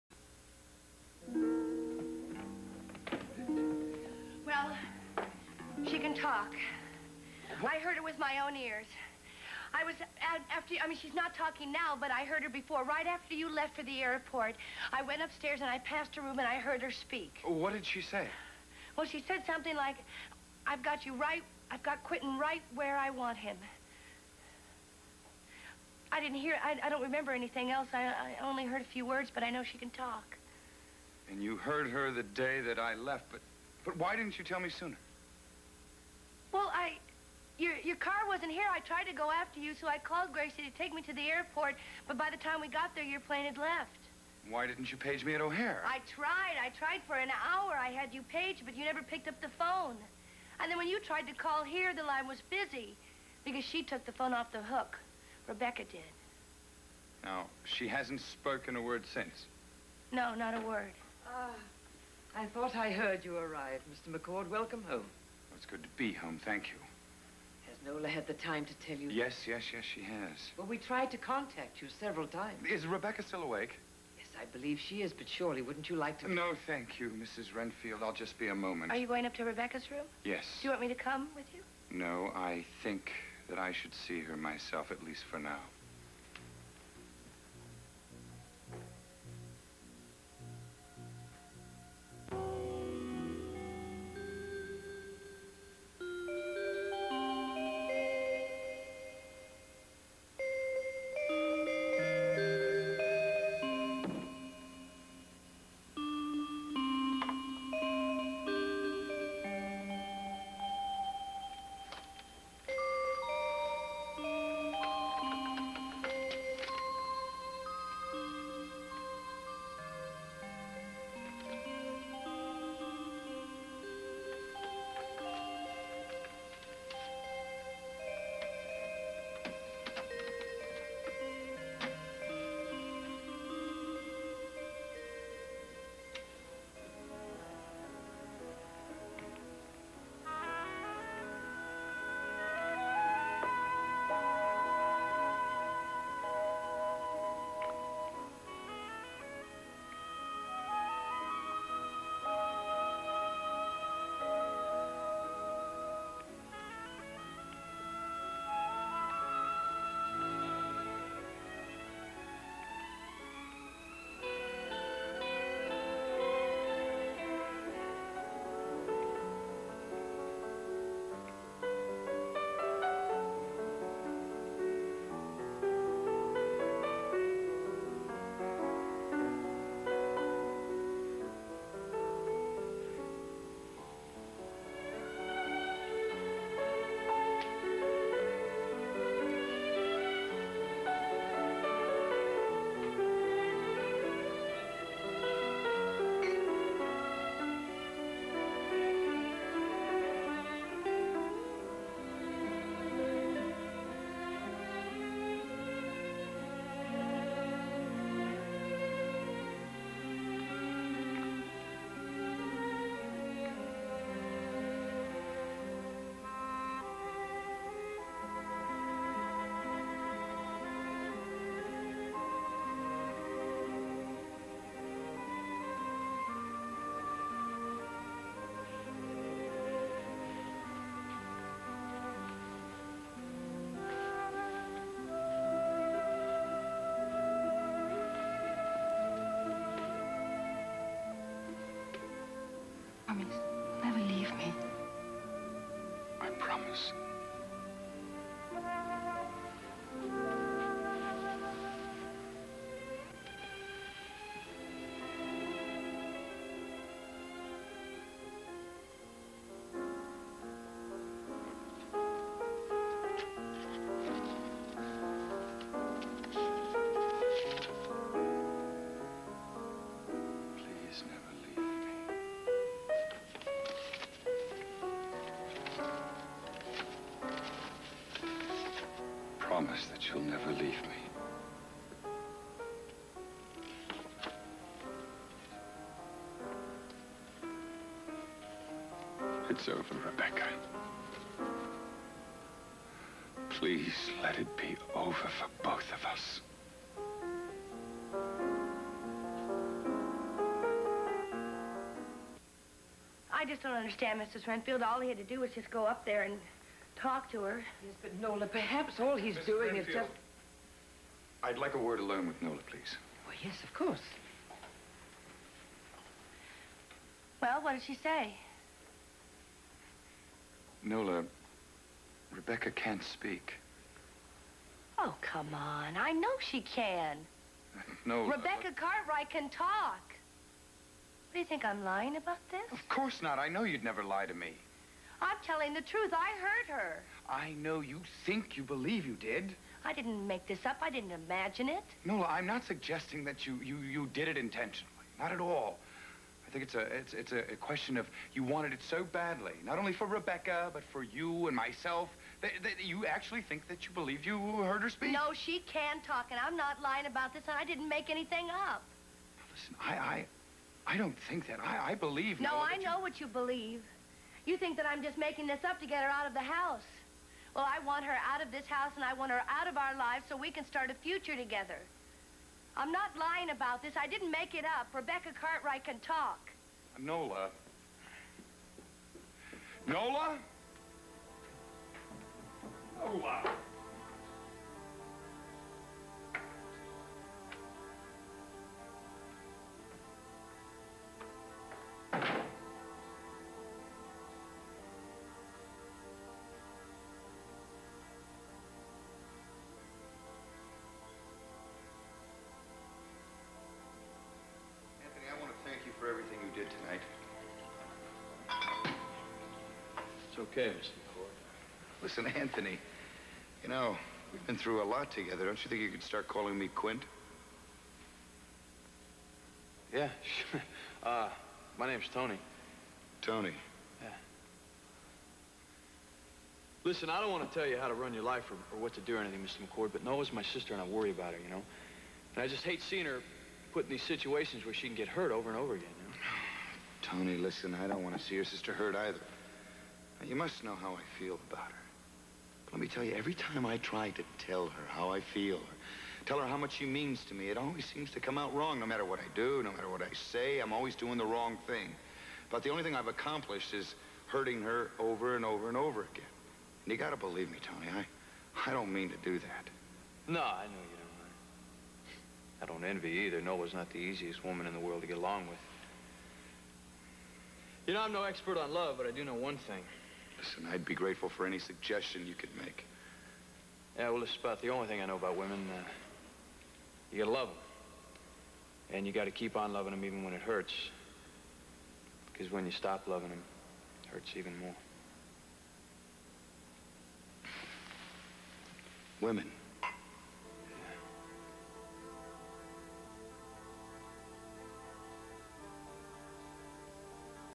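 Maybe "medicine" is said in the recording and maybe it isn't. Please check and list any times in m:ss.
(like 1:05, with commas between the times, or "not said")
not said.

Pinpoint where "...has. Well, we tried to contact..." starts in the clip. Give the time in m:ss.
1:10.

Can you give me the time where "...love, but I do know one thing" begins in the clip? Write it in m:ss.
7:48.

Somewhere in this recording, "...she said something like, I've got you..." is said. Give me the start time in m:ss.
0:19.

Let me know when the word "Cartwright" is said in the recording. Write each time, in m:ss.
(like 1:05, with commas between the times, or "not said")
5:28, 6:15.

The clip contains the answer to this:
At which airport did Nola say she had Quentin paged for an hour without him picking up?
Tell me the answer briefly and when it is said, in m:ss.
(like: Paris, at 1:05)
O'Hare, at 0:45.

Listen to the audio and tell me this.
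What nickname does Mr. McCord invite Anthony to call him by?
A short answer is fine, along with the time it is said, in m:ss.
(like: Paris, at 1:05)
Quint, at 6:56.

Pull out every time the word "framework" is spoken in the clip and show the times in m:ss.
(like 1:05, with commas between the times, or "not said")
not said.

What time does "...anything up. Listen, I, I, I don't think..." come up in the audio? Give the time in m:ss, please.
5:58.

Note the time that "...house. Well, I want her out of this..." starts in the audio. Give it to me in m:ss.
6:06.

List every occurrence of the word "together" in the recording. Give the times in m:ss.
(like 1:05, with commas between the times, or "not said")
6:11, 6:55.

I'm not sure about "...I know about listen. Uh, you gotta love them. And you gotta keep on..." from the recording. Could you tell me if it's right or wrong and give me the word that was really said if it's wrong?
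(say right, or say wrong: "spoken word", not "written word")
wrong: "women", not "listen".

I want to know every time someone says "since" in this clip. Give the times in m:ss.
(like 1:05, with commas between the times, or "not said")
0:59.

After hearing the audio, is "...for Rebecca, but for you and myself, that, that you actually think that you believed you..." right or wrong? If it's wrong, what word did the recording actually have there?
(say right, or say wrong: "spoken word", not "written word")
right.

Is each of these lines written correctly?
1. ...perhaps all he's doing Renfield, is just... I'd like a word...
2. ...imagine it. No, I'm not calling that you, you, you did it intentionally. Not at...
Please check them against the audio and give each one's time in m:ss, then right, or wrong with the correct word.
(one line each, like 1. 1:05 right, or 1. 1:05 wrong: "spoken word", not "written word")
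1. 5:08 right
2. 5:41 wrong: "suggesting", not "calling".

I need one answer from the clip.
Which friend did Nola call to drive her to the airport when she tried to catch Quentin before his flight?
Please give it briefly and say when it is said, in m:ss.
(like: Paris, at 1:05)
Gracie, at 0:40.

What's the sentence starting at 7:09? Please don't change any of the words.
McCord, but Nola's my sister and I worry about her, you know?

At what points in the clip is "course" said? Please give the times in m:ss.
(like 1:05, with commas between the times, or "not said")
5:13, 5:32.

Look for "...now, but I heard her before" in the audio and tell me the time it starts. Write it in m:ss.
0:11.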